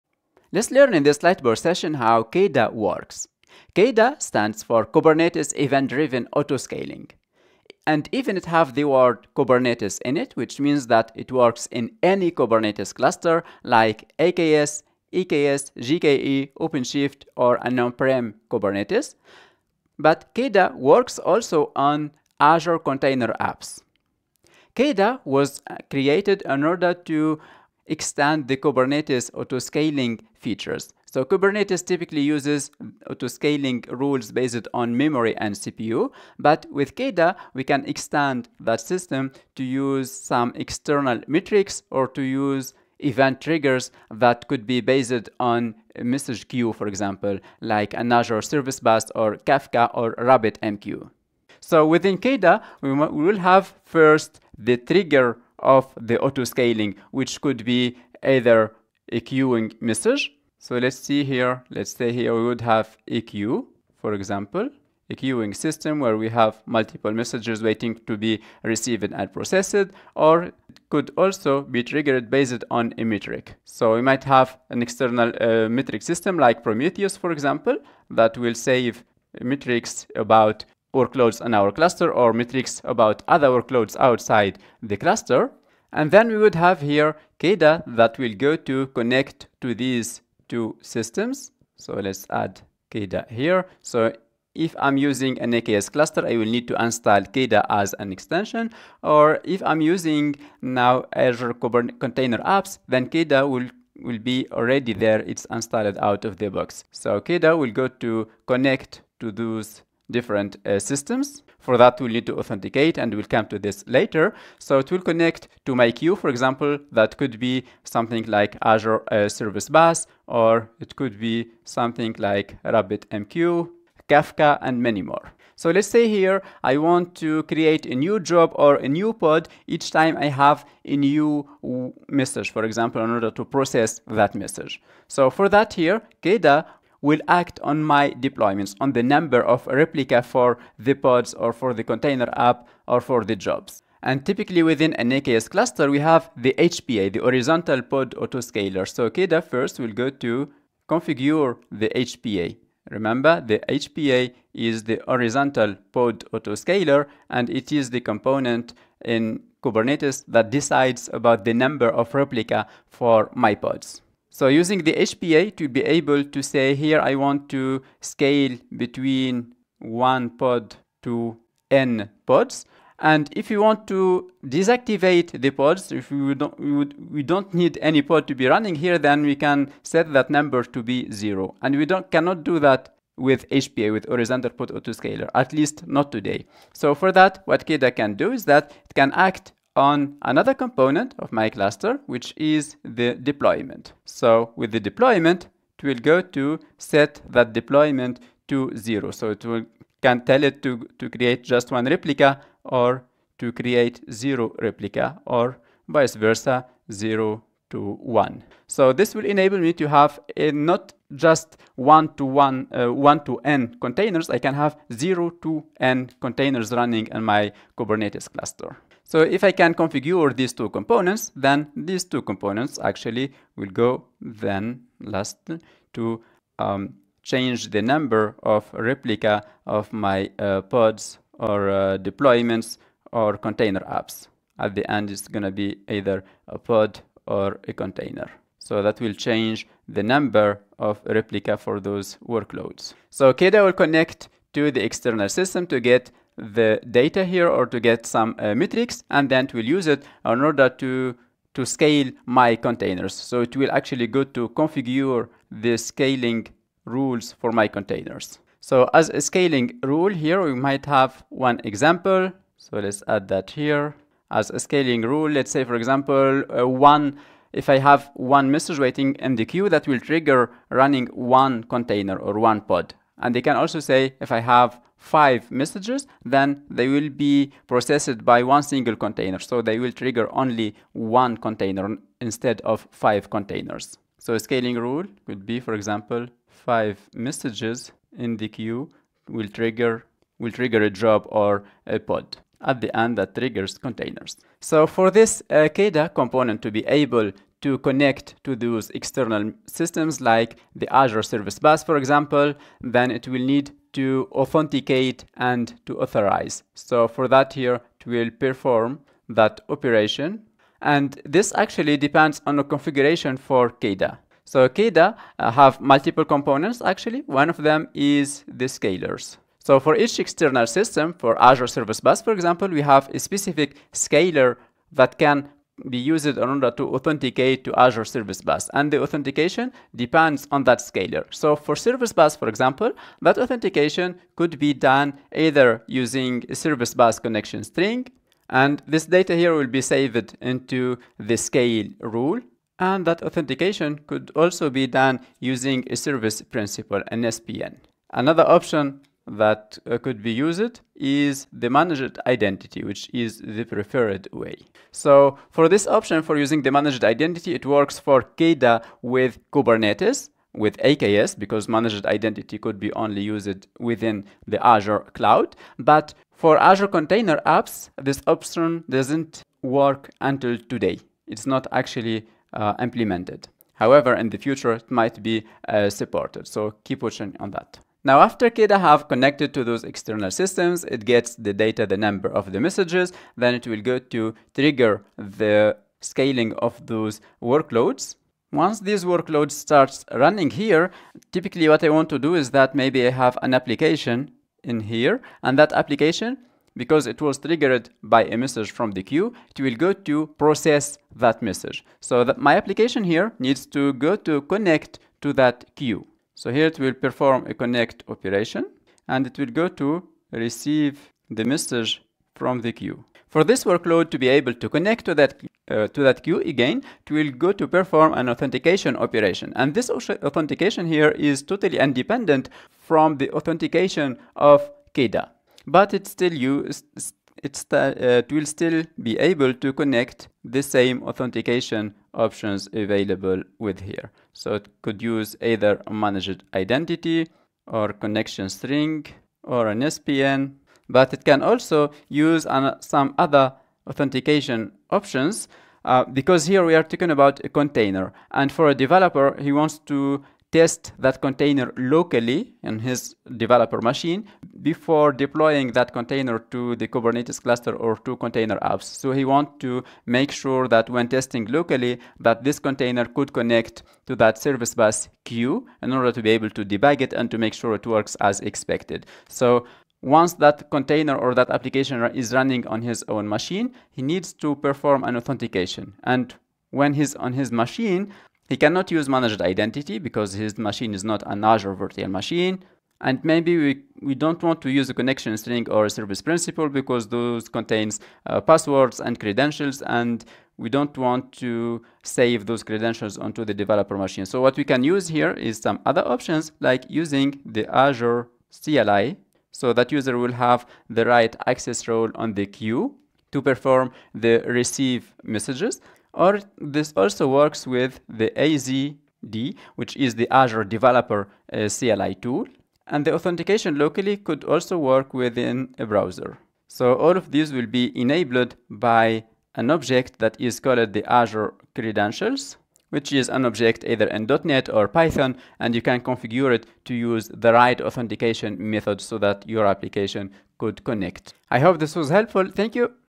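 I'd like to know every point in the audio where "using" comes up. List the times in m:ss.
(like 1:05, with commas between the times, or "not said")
1:34, 1:39, 2:44, 5:35, 5:45, 5:56, 8:16.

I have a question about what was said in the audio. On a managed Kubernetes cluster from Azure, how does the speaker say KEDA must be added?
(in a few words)
As an extension.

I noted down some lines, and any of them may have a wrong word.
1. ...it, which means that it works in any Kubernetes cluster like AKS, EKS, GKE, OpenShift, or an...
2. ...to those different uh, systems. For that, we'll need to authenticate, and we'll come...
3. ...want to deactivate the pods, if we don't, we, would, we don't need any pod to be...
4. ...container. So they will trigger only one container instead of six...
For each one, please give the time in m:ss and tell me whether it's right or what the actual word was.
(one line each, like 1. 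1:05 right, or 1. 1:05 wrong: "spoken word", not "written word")
1. 0:10 right
2. 1:49 right
3. 2:53 right
4. 4:38 wrong: "five", not "six".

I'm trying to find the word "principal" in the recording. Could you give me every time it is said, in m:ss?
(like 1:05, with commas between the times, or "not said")
5:46, 8:06.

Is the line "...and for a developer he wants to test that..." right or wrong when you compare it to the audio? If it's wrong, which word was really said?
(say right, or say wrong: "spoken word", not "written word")
right.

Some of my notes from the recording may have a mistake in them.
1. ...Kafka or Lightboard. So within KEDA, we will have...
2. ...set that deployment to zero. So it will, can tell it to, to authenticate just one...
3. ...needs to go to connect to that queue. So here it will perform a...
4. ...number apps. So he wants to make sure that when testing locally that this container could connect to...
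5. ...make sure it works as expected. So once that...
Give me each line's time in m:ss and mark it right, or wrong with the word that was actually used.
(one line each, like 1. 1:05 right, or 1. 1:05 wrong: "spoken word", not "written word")
1. 0:49 wrong: "RabbitMQ", not "Lightboard"
2. 3:16 wrong: "create", not "authenticate"
3. 6:43 right
4. 7:38 wrong: "container", not "number"
5. 7:47 right.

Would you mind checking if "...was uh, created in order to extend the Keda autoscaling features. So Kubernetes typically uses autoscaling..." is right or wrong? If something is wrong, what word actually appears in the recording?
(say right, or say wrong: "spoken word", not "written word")
wrong: "Kubernetes", not "Keda".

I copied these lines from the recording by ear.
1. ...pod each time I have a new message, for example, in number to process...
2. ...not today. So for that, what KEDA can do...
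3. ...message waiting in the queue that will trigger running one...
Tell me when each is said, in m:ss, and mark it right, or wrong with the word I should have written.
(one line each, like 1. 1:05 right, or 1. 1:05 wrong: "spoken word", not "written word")
1. 2:09 wrong: "order", not "number"
2. 3:05 right
3. 4:28 right.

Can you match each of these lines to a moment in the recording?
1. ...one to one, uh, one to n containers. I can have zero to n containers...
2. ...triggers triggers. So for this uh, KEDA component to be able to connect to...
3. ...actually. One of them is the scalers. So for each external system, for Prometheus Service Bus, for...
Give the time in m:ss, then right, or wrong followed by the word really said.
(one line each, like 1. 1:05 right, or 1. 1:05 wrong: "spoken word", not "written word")
1. 3:31 right
2. 4:53 wrong: "containers", not "triggers"
3. 5:16 wrong: "Azure", not "Prometheus".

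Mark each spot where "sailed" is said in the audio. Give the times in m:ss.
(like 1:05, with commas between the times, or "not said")
not said.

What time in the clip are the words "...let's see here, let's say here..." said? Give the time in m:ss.
1:00.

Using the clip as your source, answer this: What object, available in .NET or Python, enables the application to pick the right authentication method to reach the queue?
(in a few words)
Azure Credentials.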